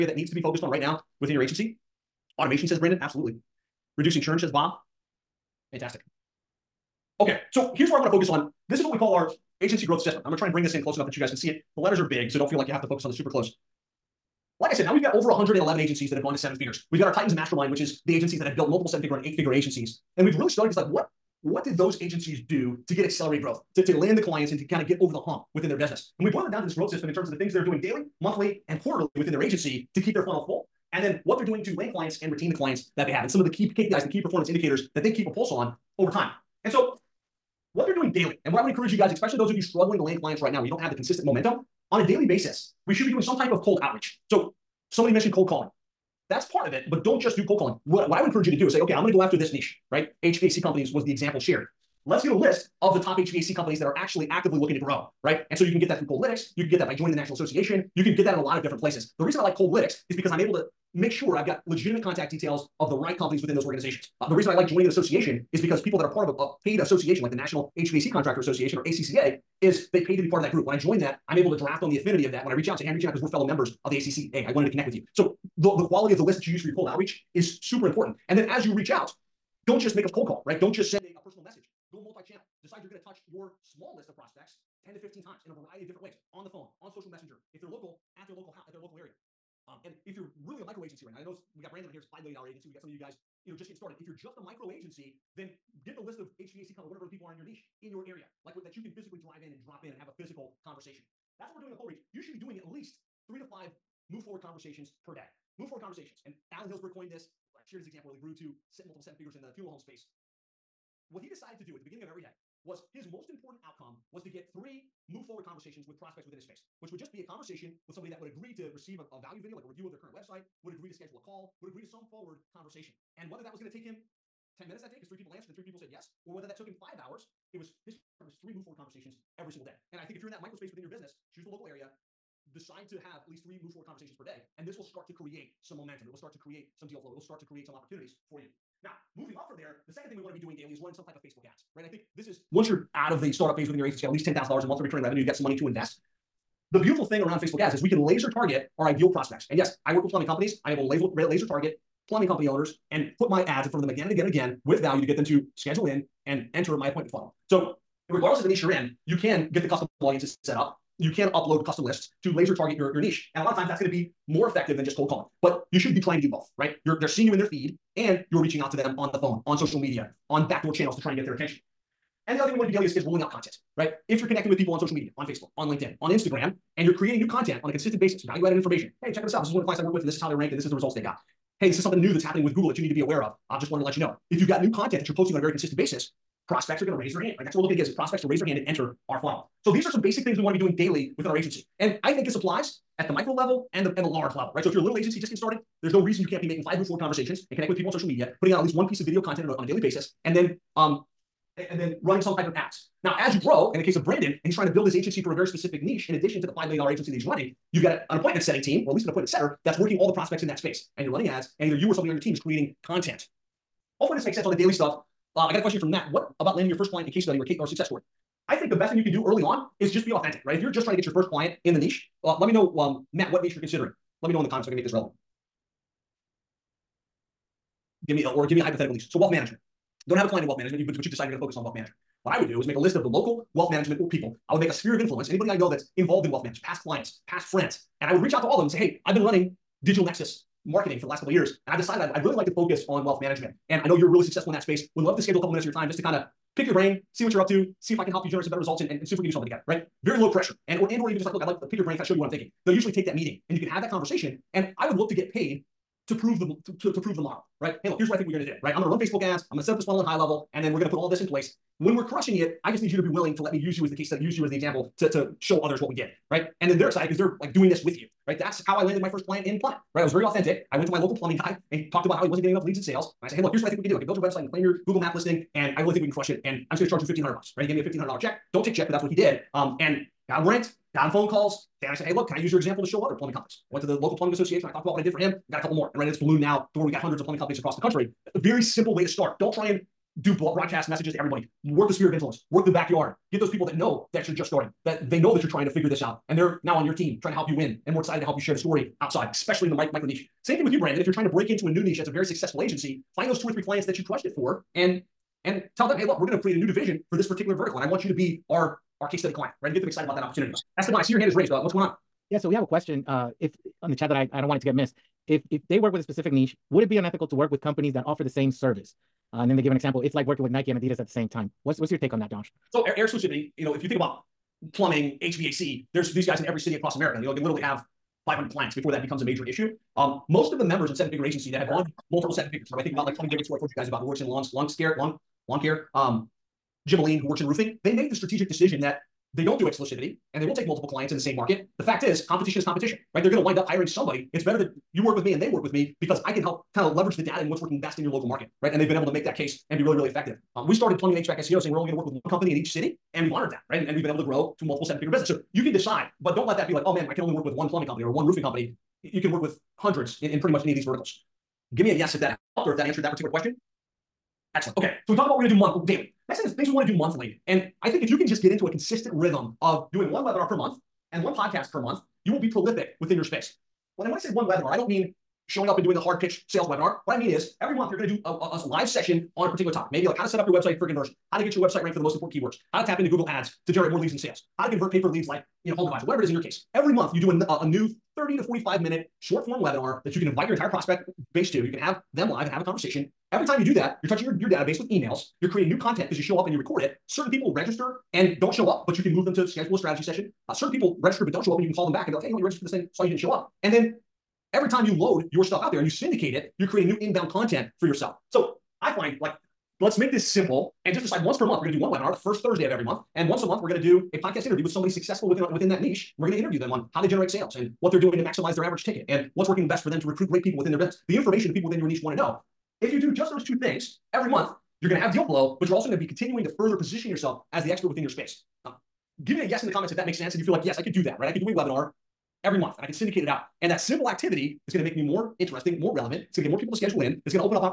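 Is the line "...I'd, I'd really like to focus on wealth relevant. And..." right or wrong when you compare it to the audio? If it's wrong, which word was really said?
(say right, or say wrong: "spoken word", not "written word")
wrong: "management", not "relevant".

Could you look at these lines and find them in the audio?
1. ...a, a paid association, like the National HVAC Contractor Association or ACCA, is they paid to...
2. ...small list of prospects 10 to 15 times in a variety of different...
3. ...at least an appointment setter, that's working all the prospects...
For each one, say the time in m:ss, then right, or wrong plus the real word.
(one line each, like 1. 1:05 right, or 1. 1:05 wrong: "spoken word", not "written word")
1. 1:06 right
2. 1:23 right
3. 3:28 right.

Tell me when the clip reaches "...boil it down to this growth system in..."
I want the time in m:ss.
0:26.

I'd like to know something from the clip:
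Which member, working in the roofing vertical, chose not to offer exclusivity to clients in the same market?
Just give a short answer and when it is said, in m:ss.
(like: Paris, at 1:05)
Jim Aline, at 5:36.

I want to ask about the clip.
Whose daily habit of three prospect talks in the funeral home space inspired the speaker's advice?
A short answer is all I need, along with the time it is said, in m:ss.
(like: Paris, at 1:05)
Alan Hillsberg, at 1:46.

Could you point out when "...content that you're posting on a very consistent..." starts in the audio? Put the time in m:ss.
3:04.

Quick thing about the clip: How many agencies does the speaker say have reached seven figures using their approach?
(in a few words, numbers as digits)
111.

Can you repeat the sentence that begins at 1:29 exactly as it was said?
Um, and if you're really a micro agency right now, I know we got Brandon on here, it's $5 million agency.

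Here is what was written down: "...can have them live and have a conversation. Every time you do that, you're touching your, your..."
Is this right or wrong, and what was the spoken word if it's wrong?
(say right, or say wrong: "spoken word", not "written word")
right.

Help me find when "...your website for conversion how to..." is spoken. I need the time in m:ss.
6:20.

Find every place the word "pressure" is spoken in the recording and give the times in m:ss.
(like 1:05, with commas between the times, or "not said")
4:10.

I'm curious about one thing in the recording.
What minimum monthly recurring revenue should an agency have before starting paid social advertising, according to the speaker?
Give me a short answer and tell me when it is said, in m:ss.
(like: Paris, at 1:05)
$10,000, at 2:24.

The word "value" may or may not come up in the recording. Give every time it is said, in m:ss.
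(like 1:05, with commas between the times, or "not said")
1:59, 2:34, 2:58.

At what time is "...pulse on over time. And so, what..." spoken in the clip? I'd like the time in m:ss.
0:35.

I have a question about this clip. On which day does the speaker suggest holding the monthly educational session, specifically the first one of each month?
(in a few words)
Thursday.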